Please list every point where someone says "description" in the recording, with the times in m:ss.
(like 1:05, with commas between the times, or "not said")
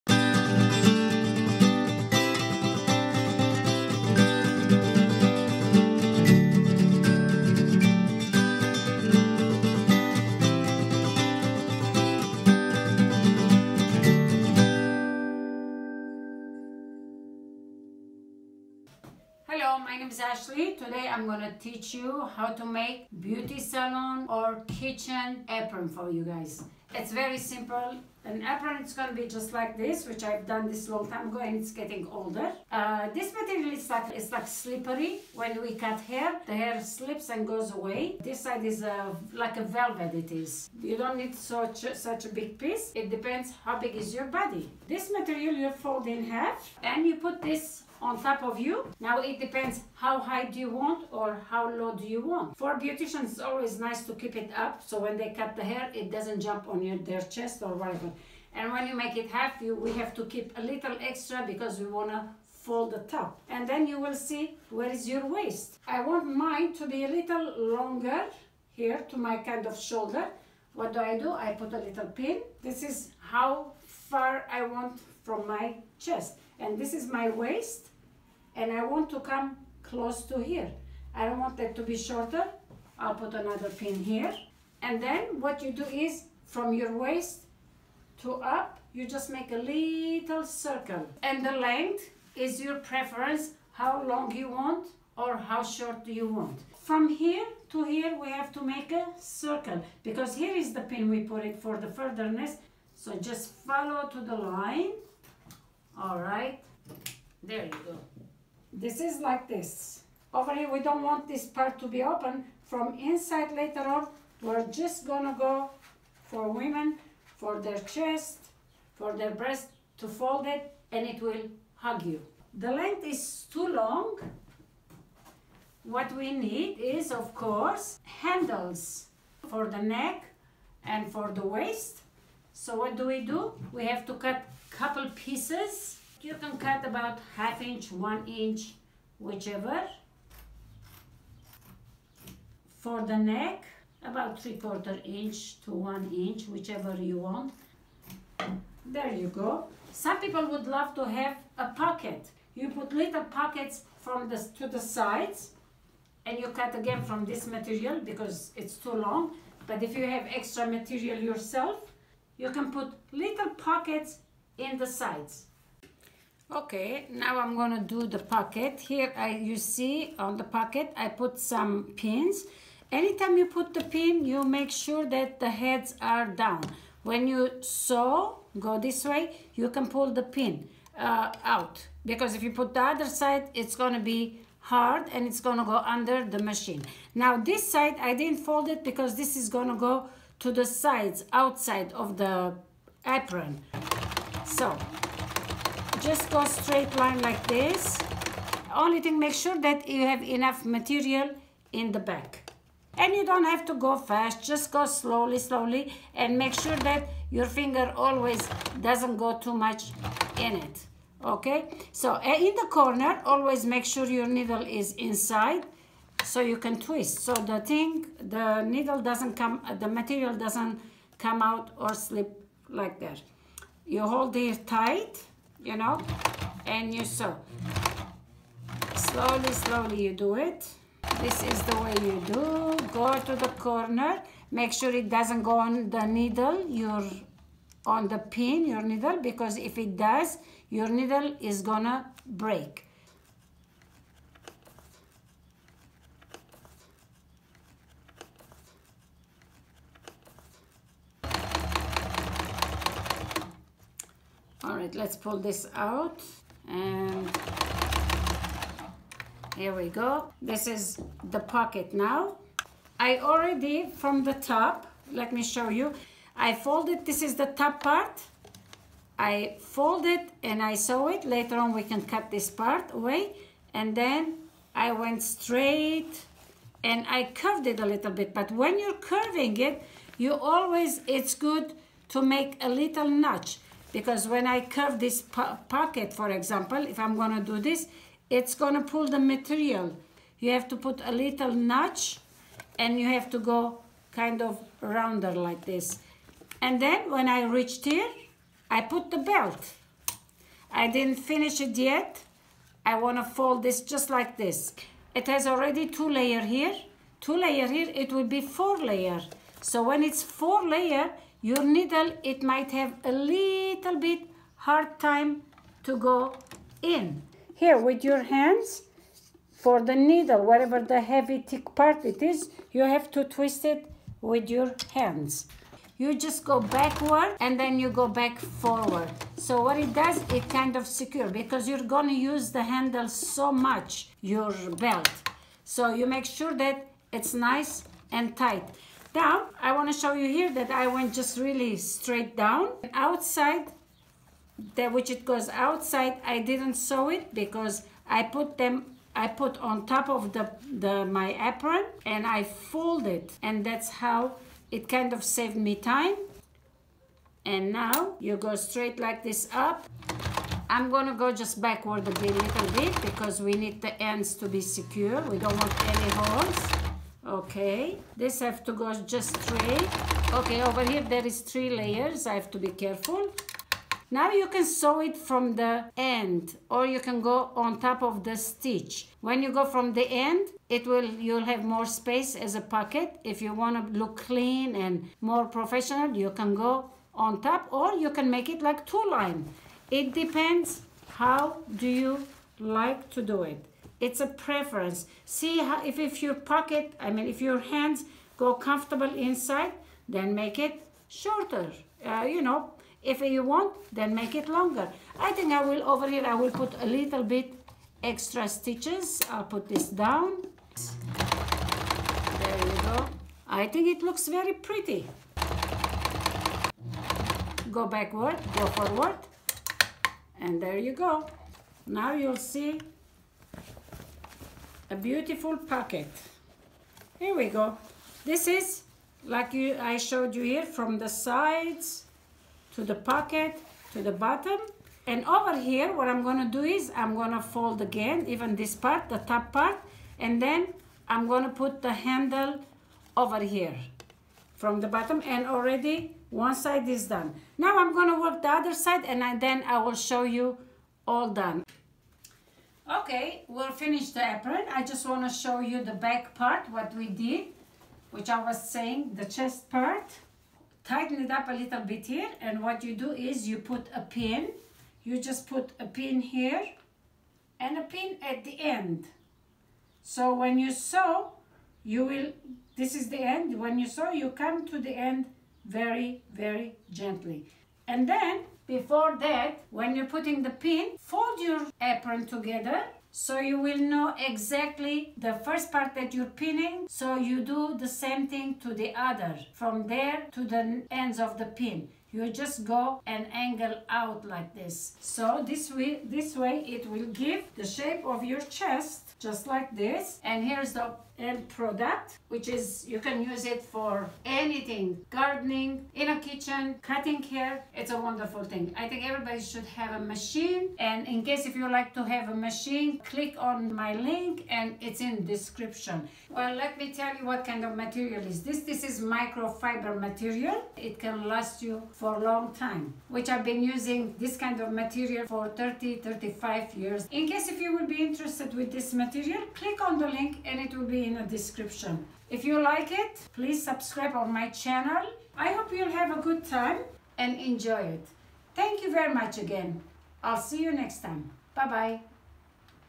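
8:35, 8:51.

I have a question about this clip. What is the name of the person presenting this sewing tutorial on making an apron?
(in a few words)
Ashley.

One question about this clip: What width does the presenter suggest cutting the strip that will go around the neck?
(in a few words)
3/4 inch to 1 inch.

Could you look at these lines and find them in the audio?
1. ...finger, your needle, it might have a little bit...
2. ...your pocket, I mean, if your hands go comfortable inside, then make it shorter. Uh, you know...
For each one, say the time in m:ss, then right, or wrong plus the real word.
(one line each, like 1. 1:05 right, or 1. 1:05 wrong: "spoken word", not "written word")
1. 5:10 wrong: "layer", not "finger"
2. 6:36 right.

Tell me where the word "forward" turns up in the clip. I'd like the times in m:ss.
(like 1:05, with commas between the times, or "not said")
5:28, 6:58.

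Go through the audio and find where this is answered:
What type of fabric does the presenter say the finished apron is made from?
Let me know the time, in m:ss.
8:39.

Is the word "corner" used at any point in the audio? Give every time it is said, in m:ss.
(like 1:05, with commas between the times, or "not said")
3:32, 3:53.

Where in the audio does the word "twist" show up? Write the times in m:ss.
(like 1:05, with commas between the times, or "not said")
3:36, 5:23.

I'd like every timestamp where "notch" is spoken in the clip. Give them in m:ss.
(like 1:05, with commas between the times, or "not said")
4:43, 4:51.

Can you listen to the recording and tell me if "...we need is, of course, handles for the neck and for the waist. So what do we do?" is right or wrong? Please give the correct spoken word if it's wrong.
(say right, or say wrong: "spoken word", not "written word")
right.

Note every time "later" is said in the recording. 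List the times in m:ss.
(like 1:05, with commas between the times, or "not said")
1:53, 4:31.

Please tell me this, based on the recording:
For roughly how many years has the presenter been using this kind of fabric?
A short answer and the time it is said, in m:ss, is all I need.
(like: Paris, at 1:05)
30-35 years, at 8:45.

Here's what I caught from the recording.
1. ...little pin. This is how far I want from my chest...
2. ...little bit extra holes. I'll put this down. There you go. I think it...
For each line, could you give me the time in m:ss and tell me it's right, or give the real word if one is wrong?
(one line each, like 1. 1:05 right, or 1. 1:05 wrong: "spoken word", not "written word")
1. 1:11 right
2. 6:46 wrong: "stitches", not "holes".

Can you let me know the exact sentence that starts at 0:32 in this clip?
Uh, this material is like, it's like slippery.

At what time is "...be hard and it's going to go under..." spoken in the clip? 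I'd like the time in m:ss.
3:03.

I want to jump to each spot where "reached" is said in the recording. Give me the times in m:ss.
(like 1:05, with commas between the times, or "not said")
4:57.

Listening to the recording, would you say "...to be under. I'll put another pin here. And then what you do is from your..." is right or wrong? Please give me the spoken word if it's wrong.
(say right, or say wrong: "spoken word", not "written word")
wrong: "shorter", not "under".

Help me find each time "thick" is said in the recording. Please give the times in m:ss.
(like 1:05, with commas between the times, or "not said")
5:21.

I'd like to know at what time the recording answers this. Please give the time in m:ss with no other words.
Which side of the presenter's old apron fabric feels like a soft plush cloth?
0:39.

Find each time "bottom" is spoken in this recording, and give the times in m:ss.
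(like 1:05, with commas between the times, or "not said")
7:14, 7:24.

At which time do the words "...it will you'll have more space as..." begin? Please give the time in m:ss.
6:20.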